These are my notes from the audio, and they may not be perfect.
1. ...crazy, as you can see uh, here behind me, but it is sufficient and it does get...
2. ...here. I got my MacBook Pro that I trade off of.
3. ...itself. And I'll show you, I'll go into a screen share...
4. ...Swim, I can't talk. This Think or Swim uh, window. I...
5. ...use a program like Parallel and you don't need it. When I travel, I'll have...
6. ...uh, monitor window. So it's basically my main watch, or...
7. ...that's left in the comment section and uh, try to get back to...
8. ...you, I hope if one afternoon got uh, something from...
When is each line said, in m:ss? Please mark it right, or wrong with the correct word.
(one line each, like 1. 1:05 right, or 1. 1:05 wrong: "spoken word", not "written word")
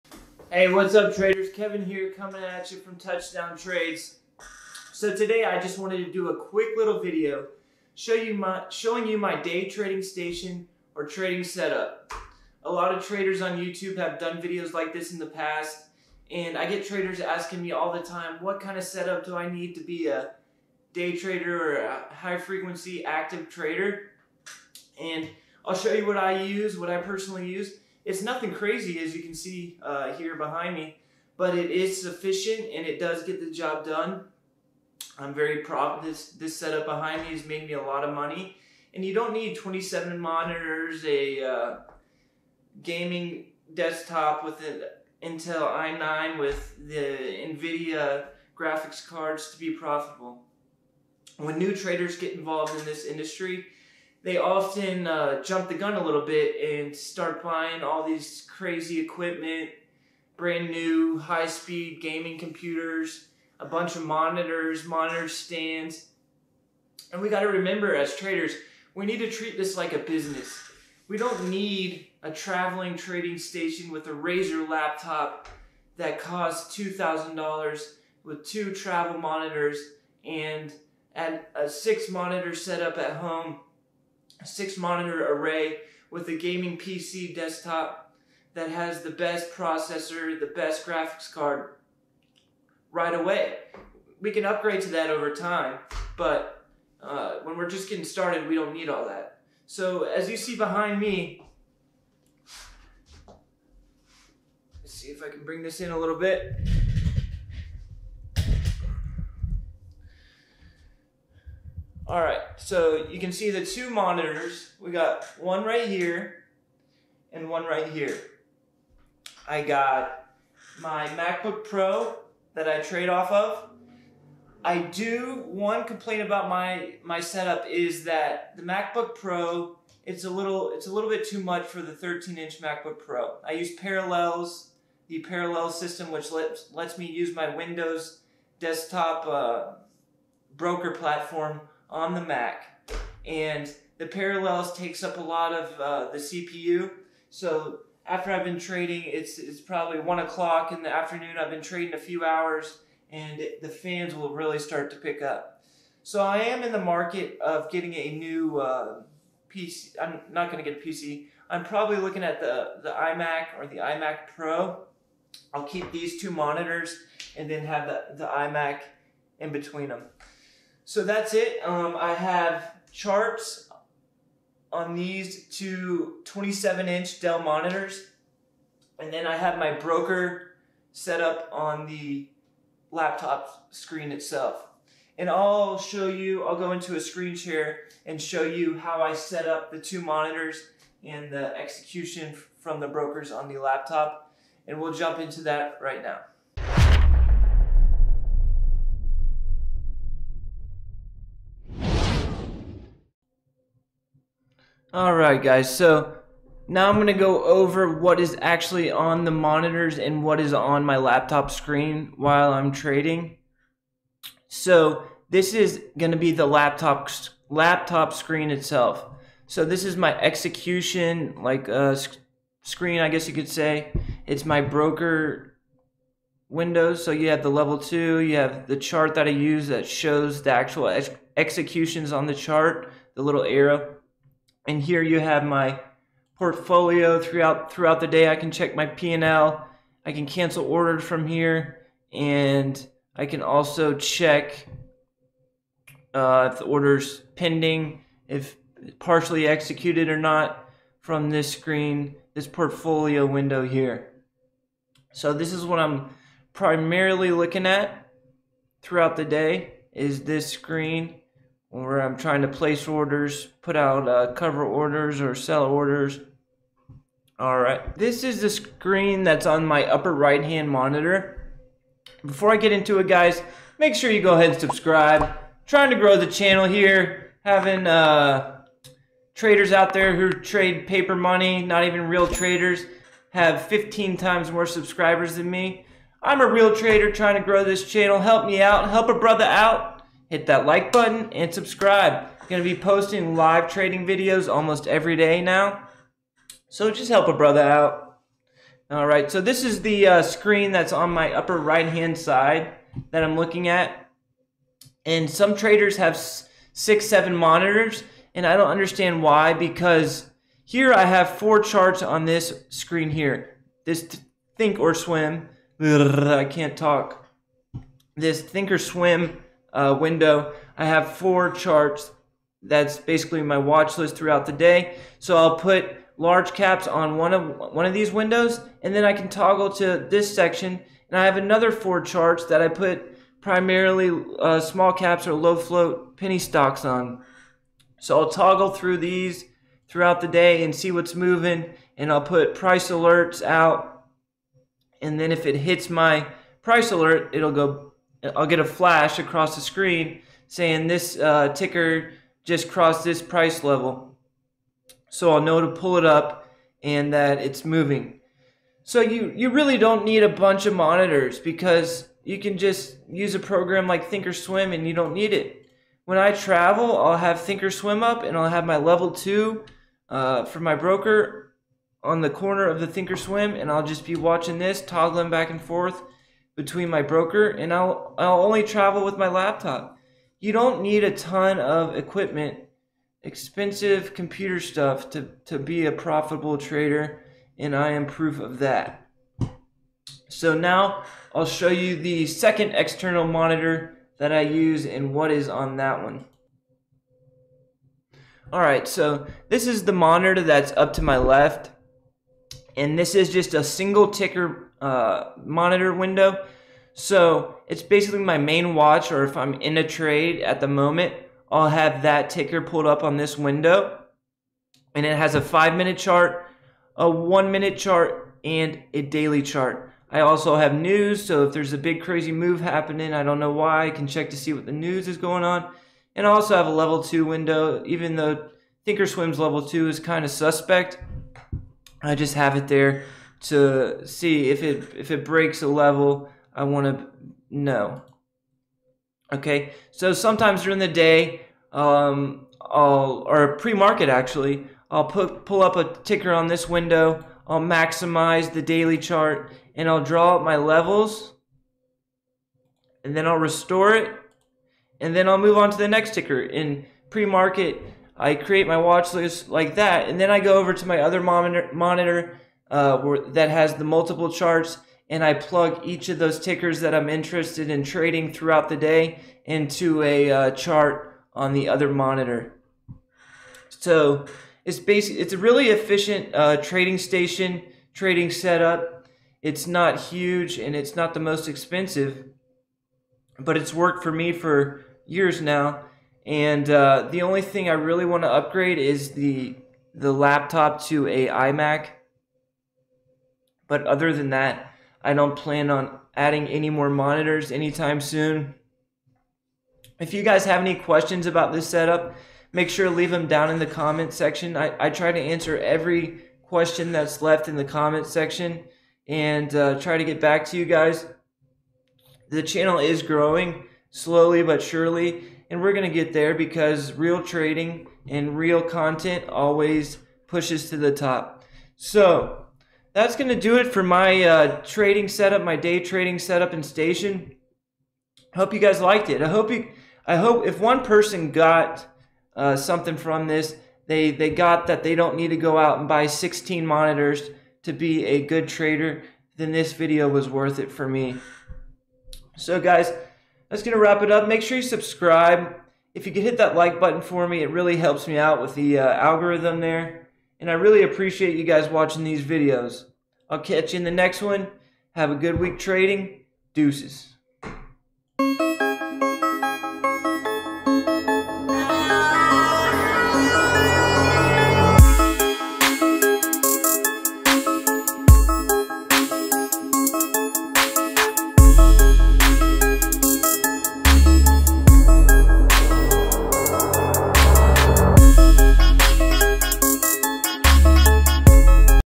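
1. 0:28 right
2. 1:57 right
3. 3:04 right
4. 5:14 right
5. 6:03 wrong: "Thinkorswim", not "Parallel"
6. 6:44 right
7. 8:26 right
8. 8:49 wrong: "person", not "afternoon".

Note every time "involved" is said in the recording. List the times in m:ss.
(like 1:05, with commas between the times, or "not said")
0:52.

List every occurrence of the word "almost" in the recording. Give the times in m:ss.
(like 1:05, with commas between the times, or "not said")
4:54.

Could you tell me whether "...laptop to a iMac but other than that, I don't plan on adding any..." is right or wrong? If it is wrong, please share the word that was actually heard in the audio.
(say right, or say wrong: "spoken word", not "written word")
right.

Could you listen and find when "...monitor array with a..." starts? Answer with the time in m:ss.
1:24.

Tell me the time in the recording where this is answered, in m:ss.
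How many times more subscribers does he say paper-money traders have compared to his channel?
4:43.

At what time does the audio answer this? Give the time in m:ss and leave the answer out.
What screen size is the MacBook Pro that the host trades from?
2:11.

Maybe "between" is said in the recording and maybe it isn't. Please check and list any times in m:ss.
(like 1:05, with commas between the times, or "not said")
2:49, 6:16.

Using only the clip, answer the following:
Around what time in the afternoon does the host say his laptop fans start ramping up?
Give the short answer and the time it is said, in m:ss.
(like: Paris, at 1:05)
one o'clock, at 2:29.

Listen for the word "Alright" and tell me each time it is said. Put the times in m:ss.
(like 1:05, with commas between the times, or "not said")
3:24.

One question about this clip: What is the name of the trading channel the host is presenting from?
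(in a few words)
Touchdown Trades.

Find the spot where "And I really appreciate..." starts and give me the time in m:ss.
9:10.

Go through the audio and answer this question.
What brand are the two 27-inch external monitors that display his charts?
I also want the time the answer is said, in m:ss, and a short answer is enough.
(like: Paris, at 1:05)
Dell, at 2:57.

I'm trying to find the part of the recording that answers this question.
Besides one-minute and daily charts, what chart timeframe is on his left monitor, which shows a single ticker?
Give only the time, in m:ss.
6:55.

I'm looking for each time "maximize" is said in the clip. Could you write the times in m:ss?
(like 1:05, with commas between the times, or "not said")
7:27.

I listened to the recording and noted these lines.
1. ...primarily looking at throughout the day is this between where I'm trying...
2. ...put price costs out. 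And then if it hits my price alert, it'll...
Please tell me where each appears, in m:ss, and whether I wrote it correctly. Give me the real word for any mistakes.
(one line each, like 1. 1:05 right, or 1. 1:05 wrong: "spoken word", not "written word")
1. 4:16 wrong: "screen", not "between"
2. 5:42 wrong: "alerts", not "costs".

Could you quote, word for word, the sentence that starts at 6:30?
So now I'll show you the second external monitor that I use and what is on that one.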